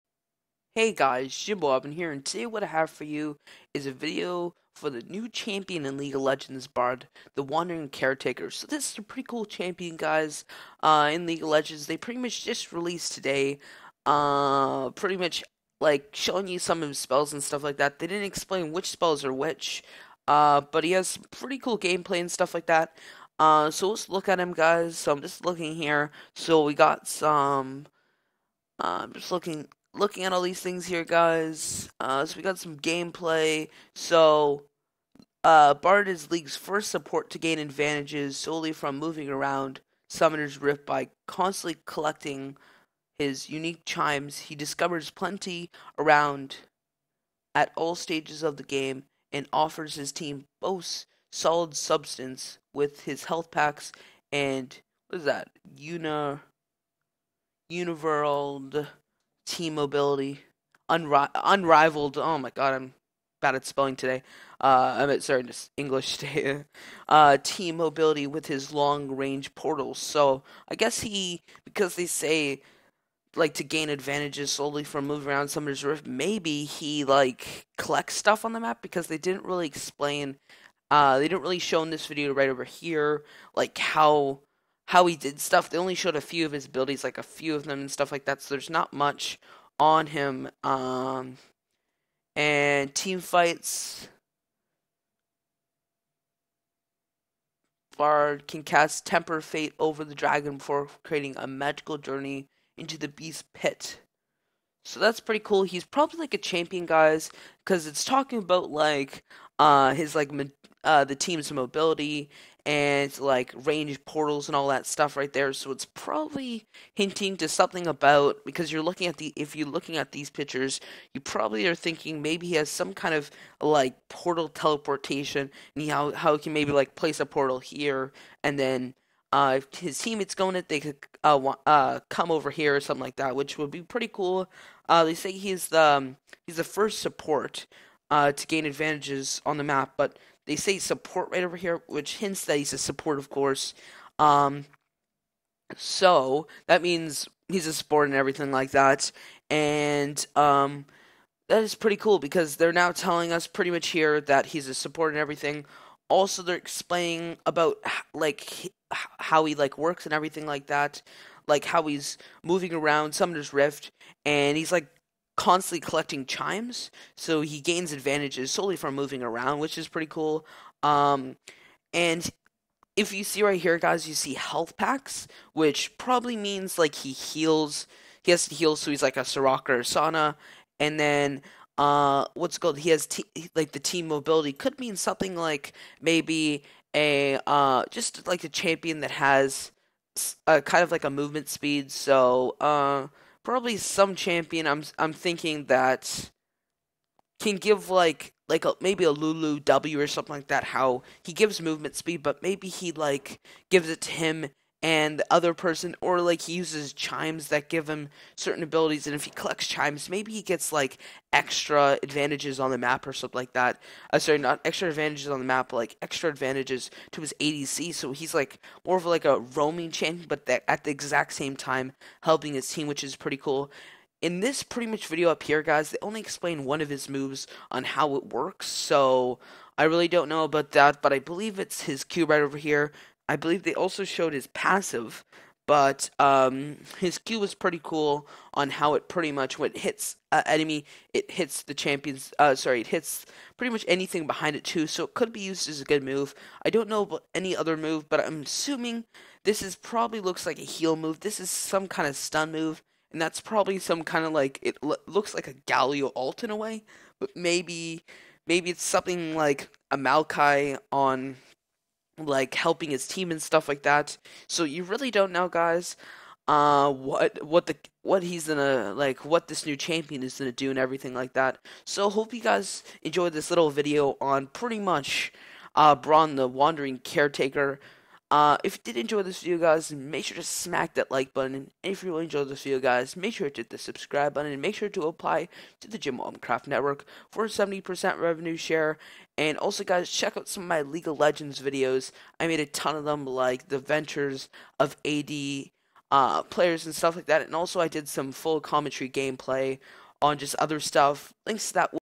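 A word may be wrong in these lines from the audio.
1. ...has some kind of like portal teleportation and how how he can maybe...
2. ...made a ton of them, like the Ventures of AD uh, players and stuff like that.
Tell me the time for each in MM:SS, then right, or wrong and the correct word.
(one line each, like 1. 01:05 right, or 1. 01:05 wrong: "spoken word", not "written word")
1. 02:02 right
2. 04:52 right.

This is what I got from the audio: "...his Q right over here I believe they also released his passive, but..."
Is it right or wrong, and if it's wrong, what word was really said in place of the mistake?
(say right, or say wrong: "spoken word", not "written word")
wrong: "showed", not "released".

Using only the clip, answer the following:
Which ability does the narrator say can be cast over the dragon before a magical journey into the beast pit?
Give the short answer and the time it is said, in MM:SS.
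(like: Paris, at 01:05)
Temper Fate, at 01:39.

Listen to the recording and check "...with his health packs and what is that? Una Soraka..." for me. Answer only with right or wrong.
wrong.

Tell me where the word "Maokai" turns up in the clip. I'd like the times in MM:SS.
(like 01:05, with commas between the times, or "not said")
04:19.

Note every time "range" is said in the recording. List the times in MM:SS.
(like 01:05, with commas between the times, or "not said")
01:09, 01:53.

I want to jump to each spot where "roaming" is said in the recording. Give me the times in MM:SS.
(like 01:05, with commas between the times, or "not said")
03:39.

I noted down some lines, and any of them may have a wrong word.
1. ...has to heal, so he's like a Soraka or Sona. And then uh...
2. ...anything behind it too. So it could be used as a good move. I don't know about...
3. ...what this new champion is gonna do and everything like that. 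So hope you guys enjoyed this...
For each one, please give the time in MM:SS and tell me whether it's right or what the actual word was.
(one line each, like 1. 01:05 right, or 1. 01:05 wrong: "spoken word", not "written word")
1. 02:58 right
2. 04:03 right
3. 04:29 right.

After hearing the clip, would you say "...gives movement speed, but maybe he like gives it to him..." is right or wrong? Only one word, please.
right.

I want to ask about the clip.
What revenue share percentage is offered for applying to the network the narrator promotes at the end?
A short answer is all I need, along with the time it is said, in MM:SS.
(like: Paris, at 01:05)
70%, at 04:47.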